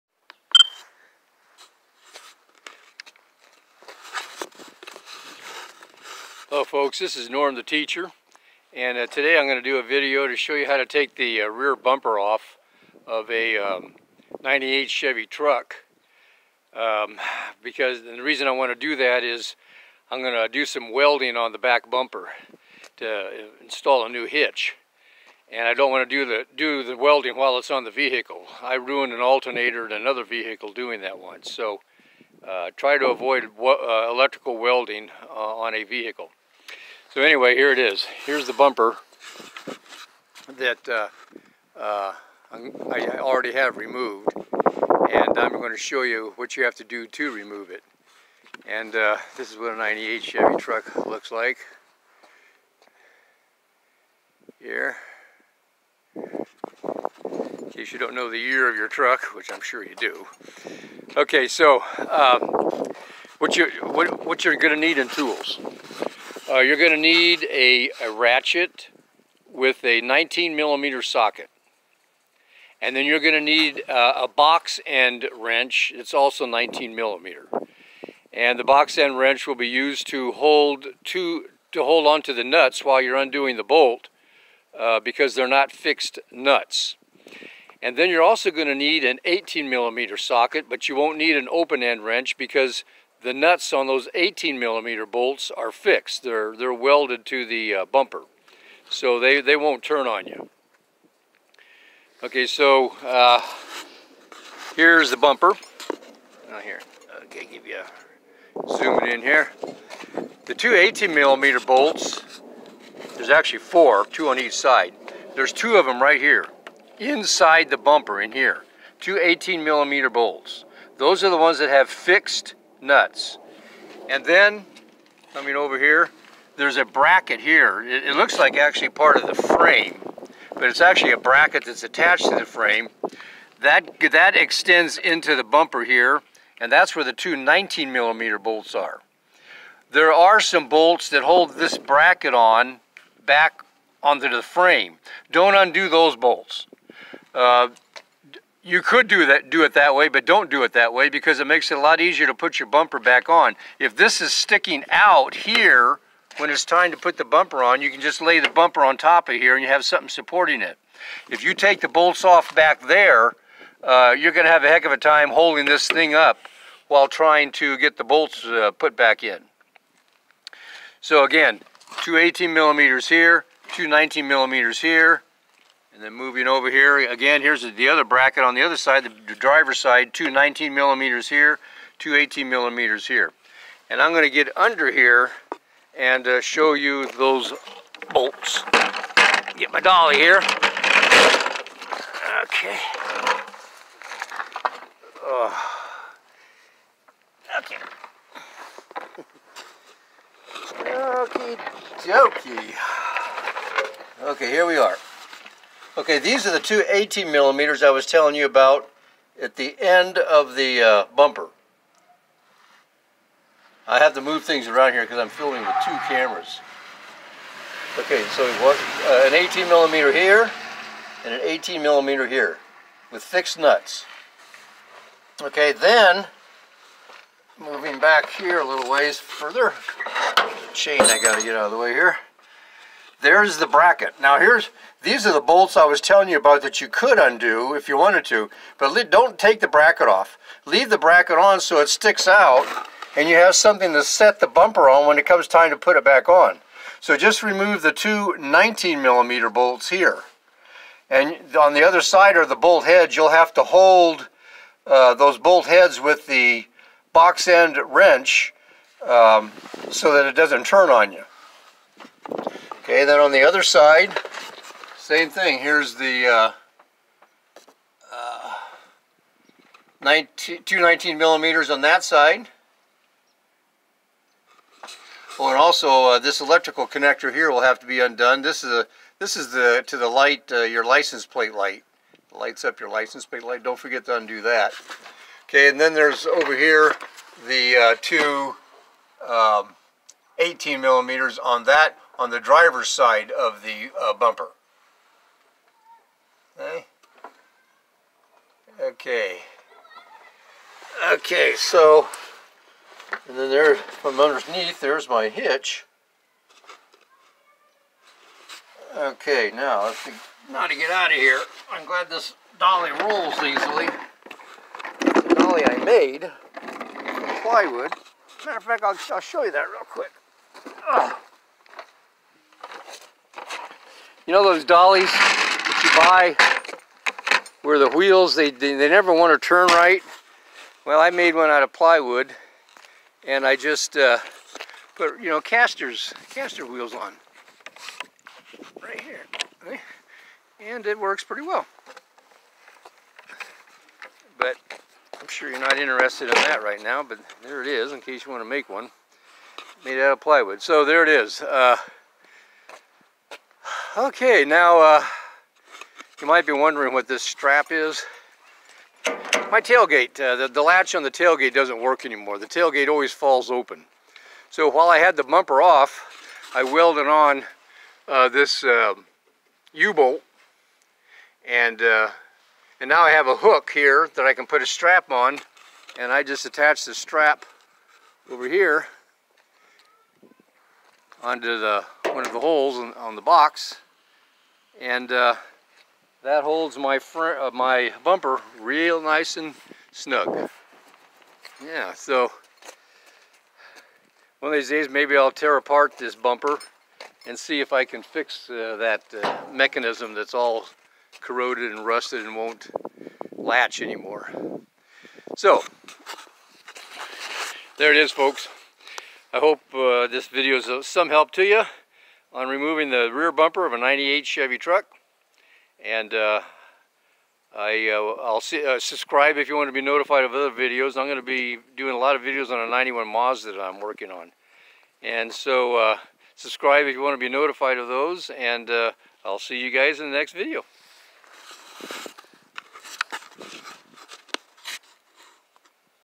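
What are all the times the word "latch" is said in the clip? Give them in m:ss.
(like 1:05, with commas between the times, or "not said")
6:00, 6:43.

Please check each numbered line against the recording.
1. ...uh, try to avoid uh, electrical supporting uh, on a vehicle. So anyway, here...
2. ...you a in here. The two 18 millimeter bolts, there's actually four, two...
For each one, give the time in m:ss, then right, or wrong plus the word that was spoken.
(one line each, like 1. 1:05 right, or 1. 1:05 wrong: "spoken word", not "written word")
1. 0:32 wrong: "welding", not "supporting"
2. 1:47 right.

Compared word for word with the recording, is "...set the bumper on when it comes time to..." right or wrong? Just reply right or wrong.
right.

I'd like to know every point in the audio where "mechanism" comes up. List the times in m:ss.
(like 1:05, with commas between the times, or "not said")
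6:39.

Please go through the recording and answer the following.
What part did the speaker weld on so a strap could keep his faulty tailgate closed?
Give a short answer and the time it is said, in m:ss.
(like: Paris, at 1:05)
U-bolt, at 6:09.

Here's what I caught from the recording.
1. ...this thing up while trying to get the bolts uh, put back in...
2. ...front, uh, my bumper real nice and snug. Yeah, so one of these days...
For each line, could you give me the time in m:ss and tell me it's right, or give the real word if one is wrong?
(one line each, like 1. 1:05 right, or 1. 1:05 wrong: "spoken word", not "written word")
1. 2:45 right
2. 6:26 right.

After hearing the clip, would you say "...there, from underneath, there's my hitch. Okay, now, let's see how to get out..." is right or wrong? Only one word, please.
right.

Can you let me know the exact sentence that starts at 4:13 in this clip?
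You'll have to hold uh, those bolt heads with the box end wrench um, so that it doesn't turn on you.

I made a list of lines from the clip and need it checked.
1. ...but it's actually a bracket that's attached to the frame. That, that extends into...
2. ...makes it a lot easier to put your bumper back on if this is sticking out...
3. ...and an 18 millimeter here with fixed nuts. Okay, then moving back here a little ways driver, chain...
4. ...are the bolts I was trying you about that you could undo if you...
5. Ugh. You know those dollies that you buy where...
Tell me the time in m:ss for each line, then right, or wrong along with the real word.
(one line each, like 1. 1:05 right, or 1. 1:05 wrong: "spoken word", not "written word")
1. 2:10 right
2. 2:31 right
3. 3:41 wrong: "further", not "driver"
4. 3:55 wrong: "telling", not "trying"
5. 5:20 right.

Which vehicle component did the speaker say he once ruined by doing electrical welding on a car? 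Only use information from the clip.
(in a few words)
alternator.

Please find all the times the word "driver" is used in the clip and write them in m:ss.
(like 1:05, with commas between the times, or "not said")
2:59, 4:52.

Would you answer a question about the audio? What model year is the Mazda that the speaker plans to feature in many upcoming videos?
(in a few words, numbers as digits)
91.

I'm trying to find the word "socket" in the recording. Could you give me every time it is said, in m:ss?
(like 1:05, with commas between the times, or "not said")
1:11, 1:30.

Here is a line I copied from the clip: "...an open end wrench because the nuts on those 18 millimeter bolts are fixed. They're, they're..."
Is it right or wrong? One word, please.
right.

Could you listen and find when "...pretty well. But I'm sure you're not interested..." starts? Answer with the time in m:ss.
5:41.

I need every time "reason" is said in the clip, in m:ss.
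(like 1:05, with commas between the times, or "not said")
0:18.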